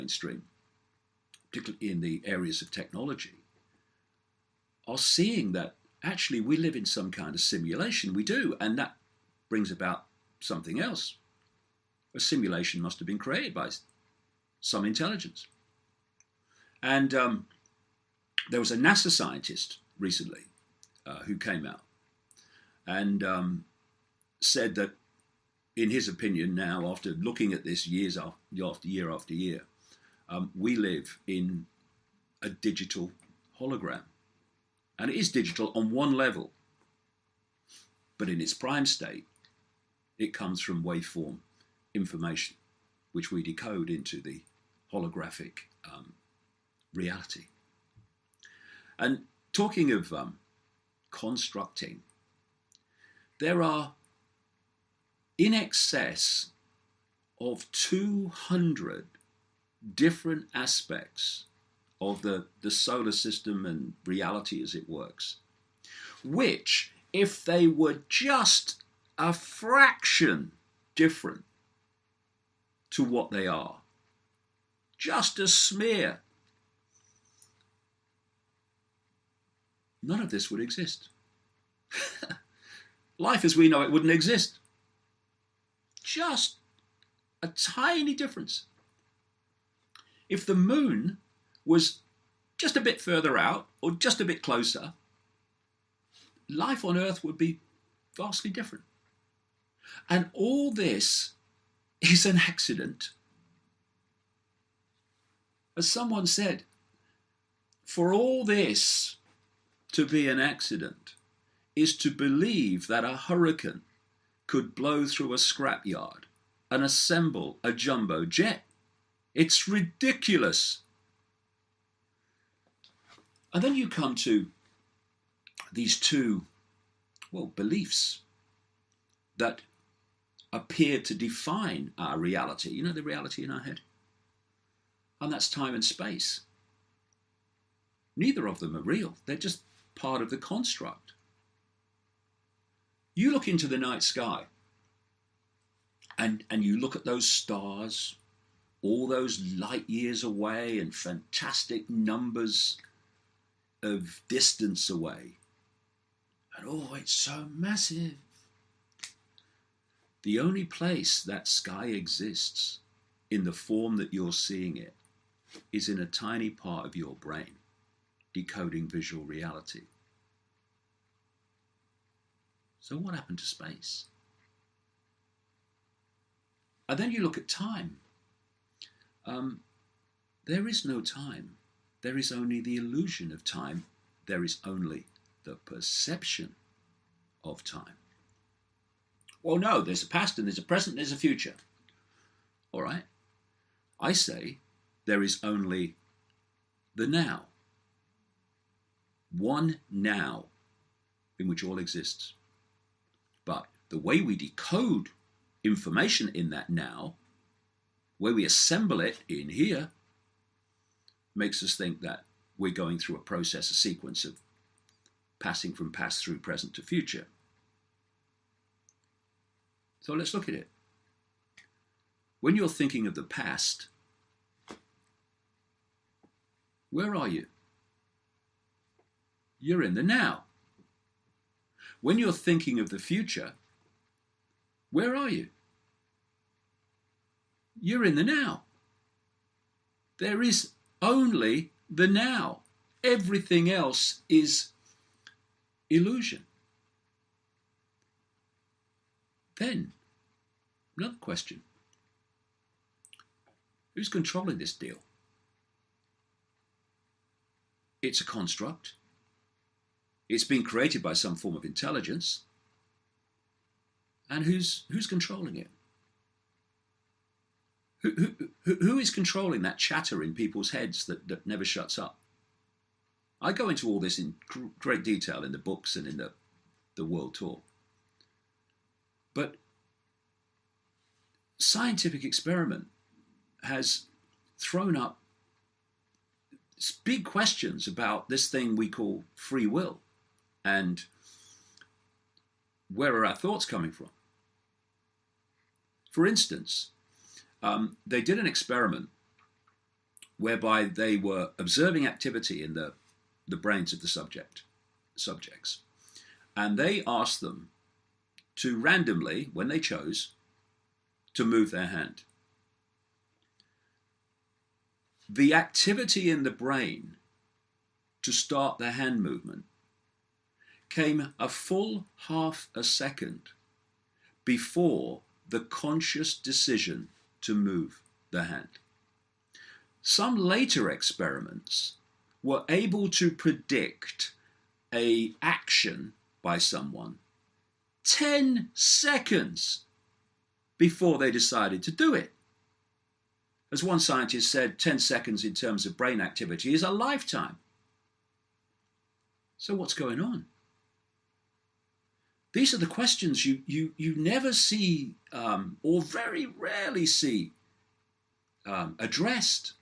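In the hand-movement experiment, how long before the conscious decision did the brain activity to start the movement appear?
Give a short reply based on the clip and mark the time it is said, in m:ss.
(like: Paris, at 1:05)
half a second, at 5:22.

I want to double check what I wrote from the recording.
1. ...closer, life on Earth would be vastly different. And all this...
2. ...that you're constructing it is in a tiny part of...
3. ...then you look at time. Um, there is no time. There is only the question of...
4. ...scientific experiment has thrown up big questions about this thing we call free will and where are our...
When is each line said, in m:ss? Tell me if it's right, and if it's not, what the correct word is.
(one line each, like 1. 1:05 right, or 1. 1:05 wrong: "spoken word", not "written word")
1. 1:34 right
2. 2:43 wrong: "seeing", not "constructing"
3. 2:56 wrong: "illusion", not "question"
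4. 4:41 right.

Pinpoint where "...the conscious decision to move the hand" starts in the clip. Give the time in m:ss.
5:25.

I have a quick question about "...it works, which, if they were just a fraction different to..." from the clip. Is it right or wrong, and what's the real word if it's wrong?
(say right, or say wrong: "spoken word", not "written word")
right.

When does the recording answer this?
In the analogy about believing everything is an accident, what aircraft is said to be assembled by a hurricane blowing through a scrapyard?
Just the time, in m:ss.
1:57.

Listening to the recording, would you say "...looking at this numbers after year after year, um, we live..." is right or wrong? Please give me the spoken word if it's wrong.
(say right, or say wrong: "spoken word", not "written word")
wrong: "years", not "numbers".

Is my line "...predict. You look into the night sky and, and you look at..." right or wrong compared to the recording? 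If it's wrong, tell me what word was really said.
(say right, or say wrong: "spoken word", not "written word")
wrong: "construct", not "predict".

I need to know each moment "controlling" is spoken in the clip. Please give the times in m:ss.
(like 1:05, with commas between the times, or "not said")
4:14, 4:25, 4:29.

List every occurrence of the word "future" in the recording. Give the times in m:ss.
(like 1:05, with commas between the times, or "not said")
3:11, 3:36, 3:52.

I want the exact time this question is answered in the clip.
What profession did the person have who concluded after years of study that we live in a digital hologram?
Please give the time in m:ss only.
0:18.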